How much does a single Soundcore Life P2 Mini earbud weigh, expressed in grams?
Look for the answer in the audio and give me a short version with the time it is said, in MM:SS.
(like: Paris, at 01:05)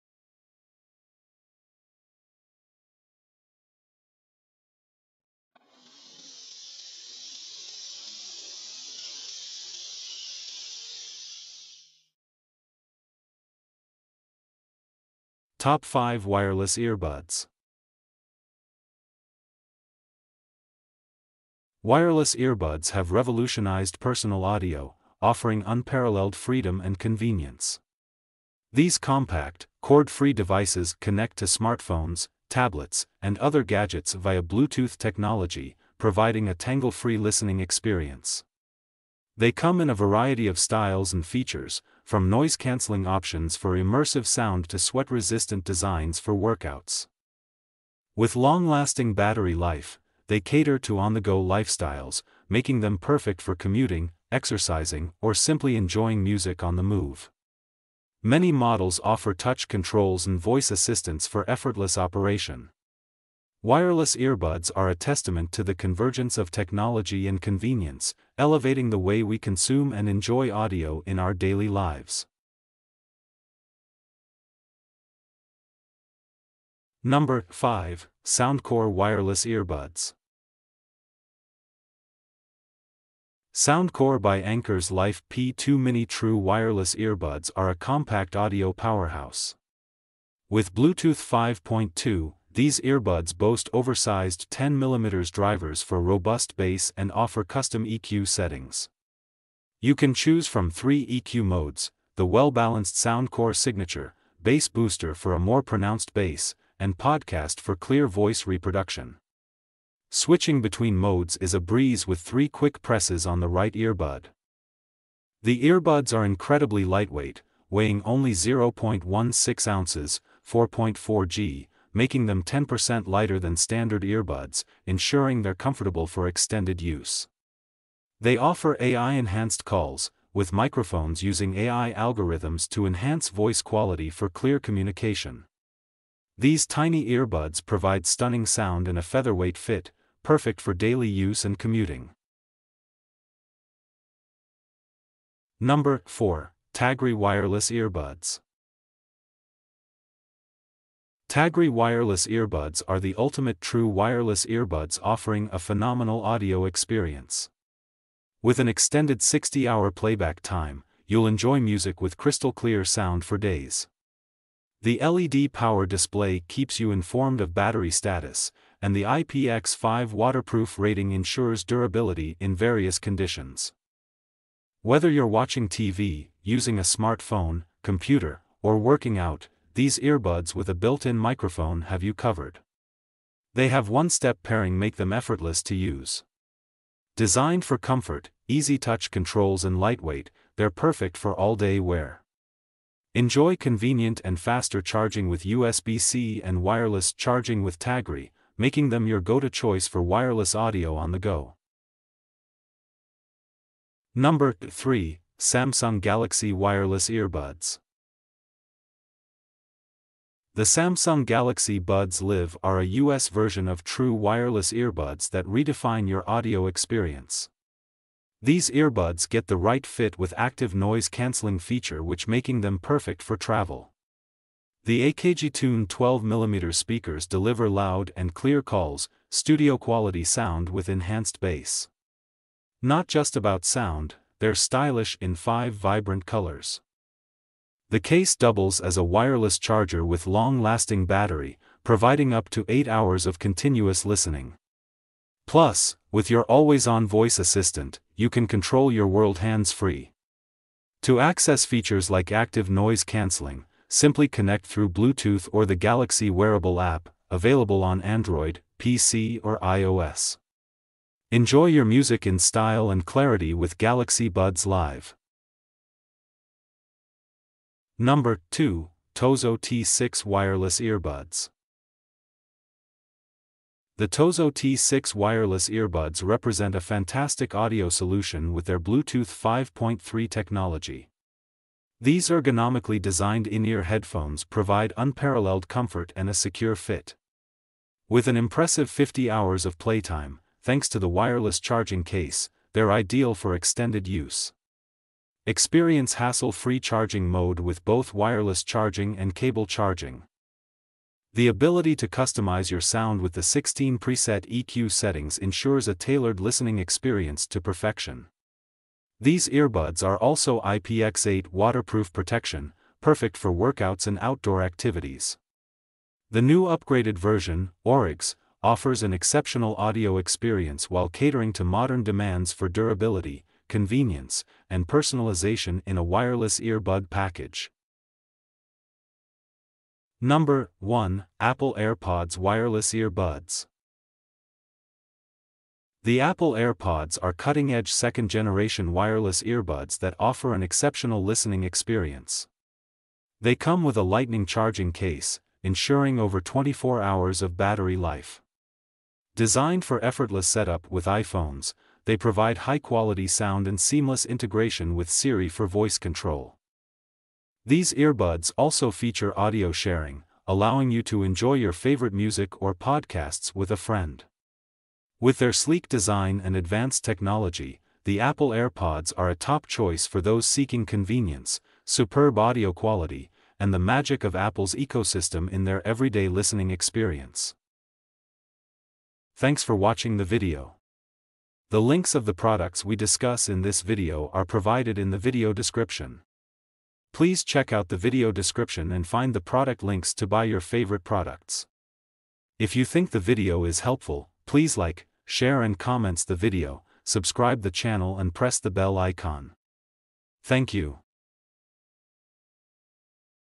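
4.4 g, at 02:00.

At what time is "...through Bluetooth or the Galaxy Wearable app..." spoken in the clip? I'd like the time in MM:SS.
04:14.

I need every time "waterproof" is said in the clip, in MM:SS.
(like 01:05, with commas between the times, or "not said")
02:50, 05:11.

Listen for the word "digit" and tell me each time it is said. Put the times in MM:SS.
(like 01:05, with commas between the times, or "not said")
not said.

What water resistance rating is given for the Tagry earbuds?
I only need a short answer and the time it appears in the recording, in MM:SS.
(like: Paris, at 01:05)
IPX5, at 02:49.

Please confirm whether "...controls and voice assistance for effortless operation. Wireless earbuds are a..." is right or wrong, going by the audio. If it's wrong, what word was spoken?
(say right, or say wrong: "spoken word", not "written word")
right.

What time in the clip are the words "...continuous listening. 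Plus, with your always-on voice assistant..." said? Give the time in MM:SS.
04:03.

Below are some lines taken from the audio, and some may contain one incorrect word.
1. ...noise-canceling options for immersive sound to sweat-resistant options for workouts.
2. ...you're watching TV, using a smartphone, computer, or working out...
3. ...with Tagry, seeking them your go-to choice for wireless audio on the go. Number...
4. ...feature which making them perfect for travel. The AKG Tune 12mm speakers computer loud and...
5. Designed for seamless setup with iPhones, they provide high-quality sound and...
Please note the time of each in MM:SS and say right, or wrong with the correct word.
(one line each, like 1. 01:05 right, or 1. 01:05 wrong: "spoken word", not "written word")
1. 00:42 wrong: "designs", not "options"
2. 02:55 right
3. 03:17 wrong: "making", not "seeking"
4. 03:41 wrong: "deliver", not "computer"
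5. 05:49 wrong: "effortless", not "seamless".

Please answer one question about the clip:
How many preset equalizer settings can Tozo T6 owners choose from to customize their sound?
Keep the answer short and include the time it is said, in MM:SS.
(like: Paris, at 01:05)
16, at 05:03.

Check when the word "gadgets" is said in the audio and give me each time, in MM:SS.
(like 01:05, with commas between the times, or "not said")
00:33.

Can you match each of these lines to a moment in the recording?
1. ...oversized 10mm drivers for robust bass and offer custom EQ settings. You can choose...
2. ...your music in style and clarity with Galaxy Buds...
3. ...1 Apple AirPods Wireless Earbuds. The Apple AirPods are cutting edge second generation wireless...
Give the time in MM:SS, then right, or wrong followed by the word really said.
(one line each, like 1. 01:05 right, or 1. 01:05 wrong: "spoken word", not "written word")
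1. 01:33 right
2. 04:21 right
3. 05:30 right.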